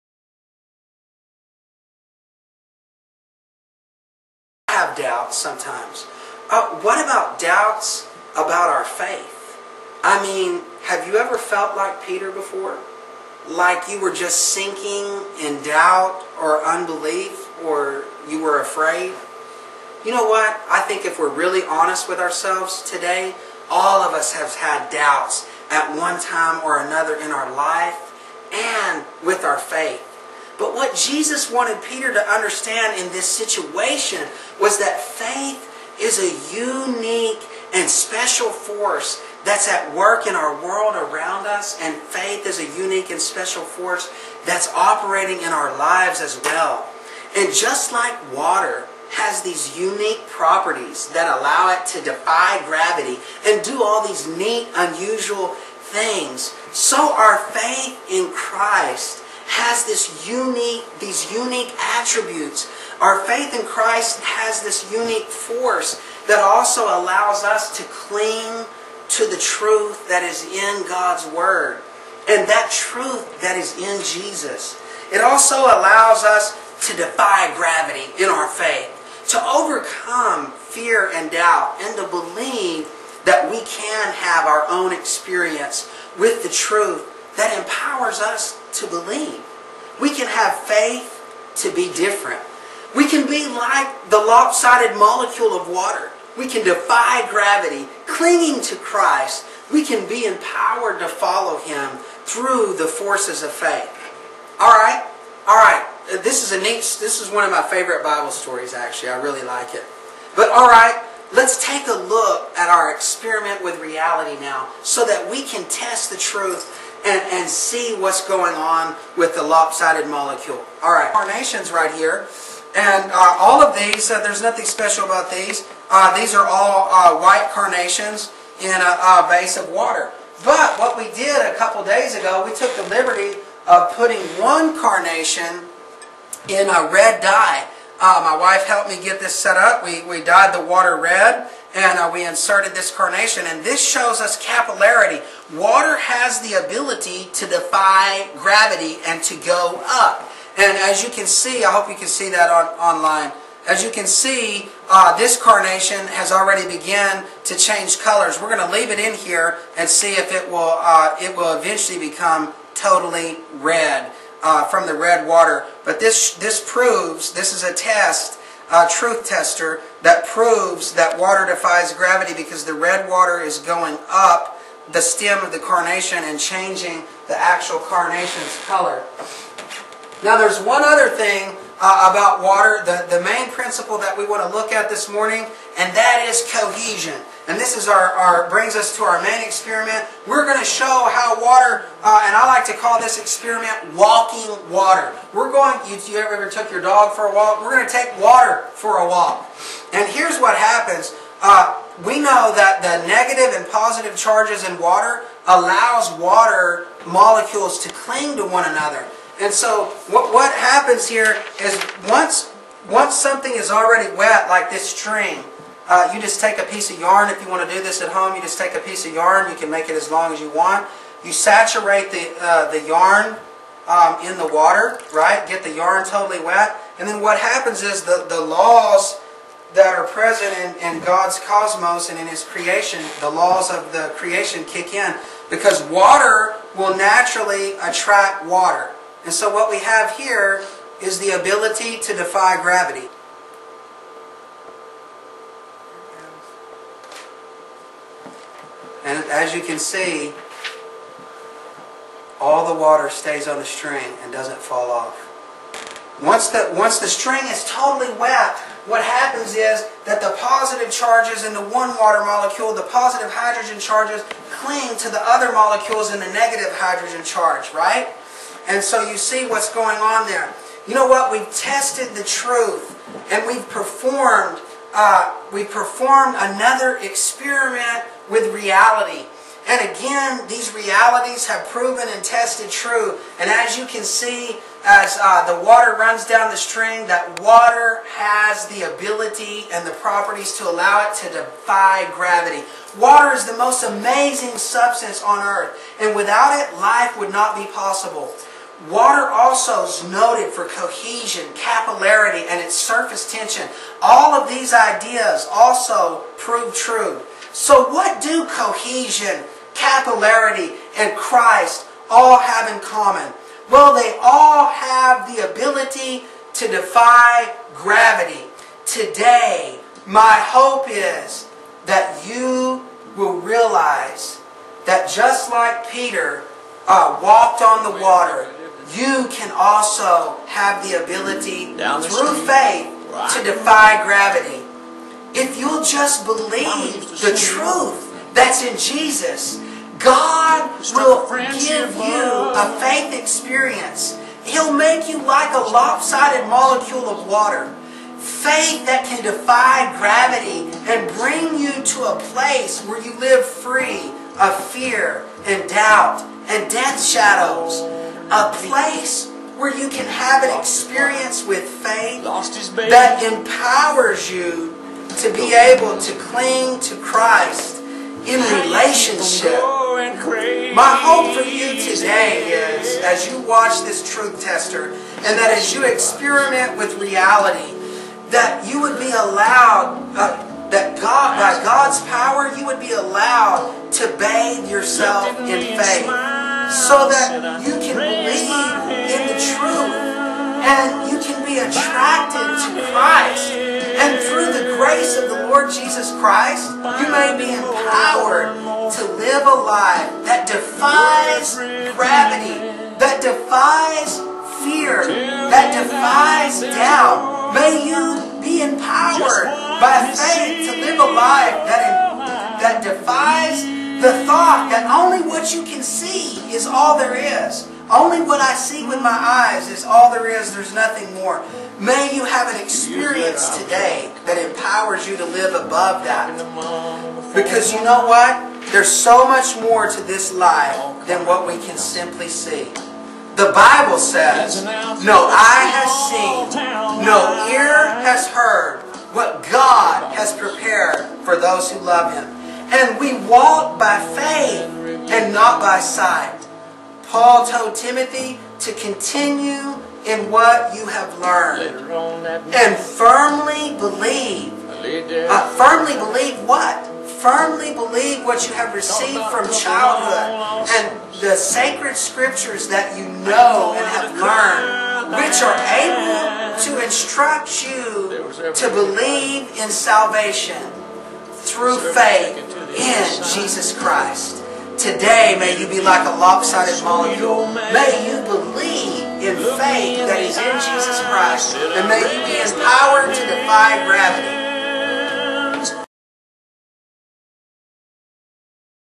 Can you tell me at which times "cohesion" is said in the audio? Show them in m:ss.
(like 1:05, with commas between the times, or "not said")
3:06, 5:00, 5:08.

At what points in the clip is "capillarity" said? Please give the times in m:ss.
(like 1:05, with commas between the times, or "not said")
2:24, 5:01, 5:09.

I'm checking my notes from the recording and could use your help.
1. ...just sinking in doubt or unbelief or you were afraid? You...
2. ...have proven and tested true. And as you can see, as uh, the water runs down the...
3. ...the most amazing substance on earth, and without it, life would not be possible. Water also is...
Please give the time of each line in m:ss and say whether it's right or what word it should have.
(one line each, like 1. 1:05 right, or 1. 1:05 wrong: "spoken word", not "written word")
1. 0:14 right
2. 4:41 right
3. 4:53 right.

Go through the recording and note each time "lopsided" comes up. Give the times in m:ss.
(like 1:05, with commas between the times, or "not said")
1:34, 1:59, 5:45, 7:56.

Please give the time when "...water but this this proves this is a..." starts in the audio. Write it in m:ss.
2:45.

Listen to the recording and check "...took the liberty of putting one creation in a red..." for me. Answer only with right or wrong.
wrong.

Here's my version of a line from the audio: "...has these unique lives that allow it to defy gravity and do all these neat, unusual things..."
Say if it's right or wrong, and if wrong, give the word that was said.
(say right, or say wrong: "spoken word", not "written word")
wrong: "properties", not "lives".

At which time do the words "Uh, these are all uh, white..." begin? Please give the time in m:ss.
2:05.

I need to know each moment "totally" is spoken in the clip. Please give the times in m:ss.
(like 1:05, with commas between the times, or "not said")
2:42, 3:46, 4:17.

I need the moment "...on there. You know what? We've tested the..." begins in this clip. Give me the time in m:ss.
4:29.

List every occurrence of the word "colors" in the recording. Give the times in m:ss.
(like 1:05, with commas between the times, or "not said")
2:37, 2:58.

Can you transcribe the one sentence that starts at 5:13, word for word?
Well, they all have the ability to defy gravity.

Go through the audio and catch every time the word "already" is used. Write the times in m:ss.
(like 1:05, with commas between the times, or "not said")
2:36, 3:33.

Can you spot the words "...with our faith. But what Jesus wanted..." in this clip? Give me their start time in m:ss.
0:29.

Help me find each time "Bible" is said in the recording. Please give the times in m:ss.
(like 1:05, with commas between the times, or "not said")
1:48, 7:13.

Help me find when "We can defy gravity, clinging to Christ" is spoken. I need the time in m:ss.
1:36.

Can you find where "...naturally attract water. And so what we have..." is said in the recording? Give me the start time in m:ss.
3:56.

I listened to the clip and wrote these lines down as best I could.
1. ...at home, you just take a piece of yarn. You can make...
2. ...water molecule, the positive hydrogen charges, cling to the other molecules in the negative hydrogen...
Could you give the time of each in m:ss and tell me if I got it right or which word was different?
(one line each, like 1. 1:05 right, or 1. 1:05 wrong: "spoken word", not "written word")
1. 3:38 right
2. 4:21 right.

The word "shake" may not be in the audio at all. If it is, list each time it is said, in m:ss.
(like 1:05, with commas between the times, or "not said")
not said.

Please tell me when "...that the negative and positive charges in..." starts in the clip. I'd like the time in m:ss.
3:22.